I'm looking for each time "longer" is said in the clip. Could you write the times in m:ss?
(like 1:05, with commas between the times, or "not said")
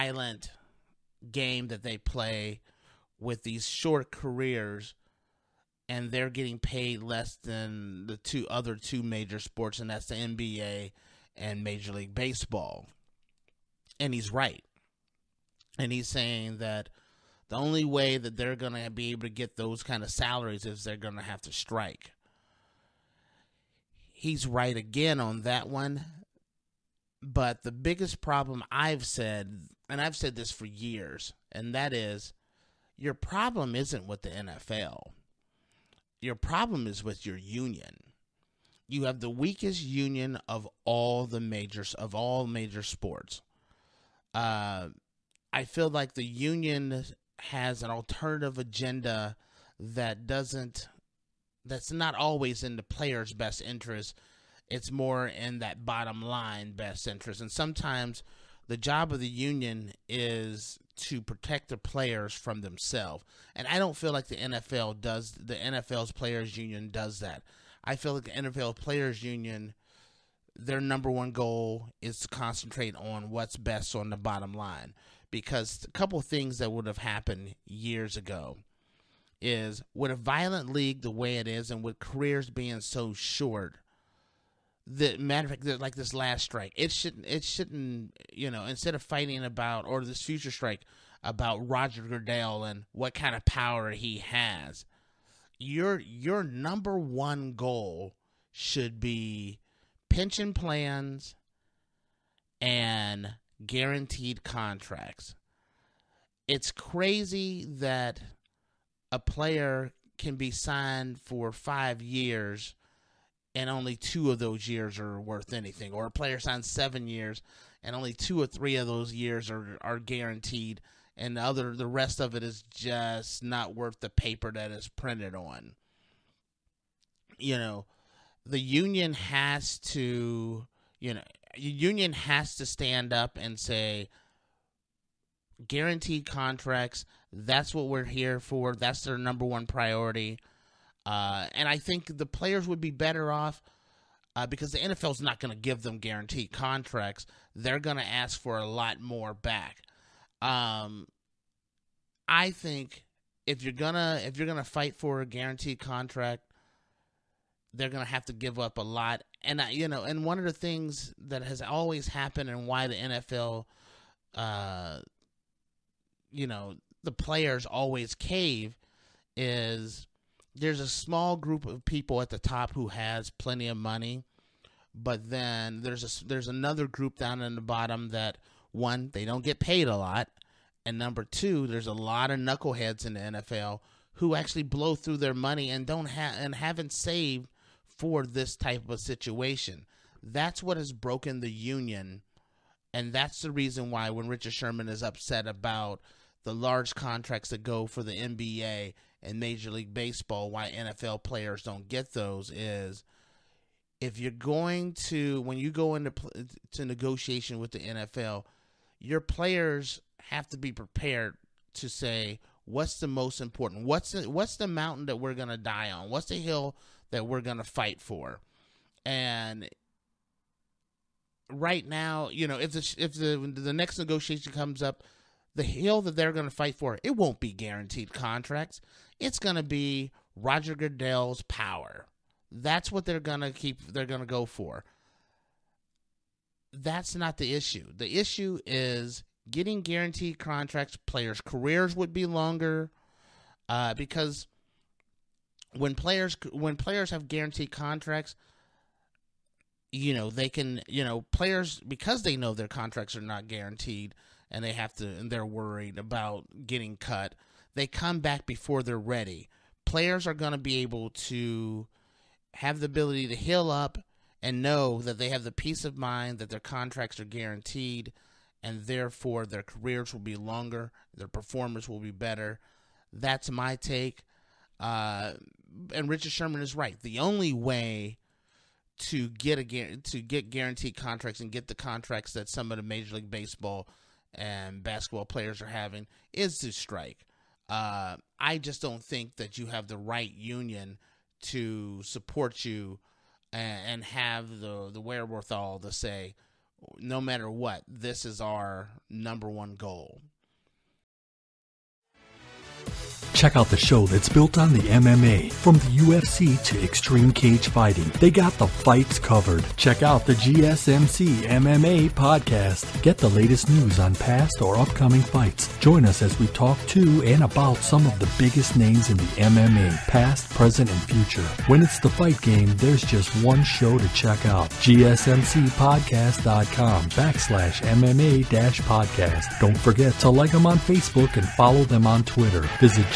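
4:02, 4:30.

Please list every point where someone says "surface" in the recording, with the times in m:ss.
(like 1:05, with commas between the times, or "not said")
not said.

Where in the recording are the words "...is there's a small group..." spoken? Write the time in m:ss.
2:49.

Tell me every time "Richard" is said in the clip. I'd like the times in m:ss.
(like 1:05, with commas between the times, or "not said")
3:14, 4:36.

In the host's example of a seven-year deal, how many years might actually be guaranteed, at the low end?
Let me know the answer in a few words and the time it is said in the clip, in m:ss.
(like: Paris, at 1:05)
2, at 1:58.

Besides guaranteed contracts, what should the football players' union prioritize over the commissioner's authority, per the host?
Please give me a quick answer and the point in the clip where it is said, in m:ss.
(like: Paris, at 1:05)
Pension plans, at 1:40.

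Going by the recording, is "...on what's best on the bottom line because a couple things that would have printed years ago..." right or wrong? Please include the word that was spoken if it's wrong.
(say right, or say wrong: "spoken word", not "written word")
wrong: "happened", not "printed".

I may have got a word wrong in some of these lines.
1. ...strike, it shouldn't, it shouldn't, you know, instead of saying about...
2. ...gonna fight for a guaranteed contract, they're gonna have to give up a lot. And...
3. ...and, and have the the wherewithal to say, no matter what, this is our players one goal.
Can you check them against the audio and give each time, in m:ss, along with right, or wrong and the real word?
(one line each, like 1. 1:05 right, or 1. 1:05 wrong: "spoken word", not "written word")
1. 1:26 wrong: "fighting", not "saying"
2. 2:34 right
3. 4:53 wrong: "number", not "players".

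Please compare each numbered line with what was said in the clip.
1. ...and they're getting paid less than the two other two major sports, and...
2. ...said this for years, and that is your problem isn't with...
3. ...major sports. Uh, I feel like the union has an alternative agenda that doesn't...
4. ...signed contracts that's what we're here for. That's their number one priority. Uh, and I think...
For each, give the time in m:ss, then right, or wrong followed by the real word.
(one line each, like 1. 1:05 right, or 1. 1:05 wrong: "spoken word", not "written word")
1. 0:05 right
2. 0:30 right
3. 0:42 right
4. 2:15 wrong: "guaranteed", not "signed".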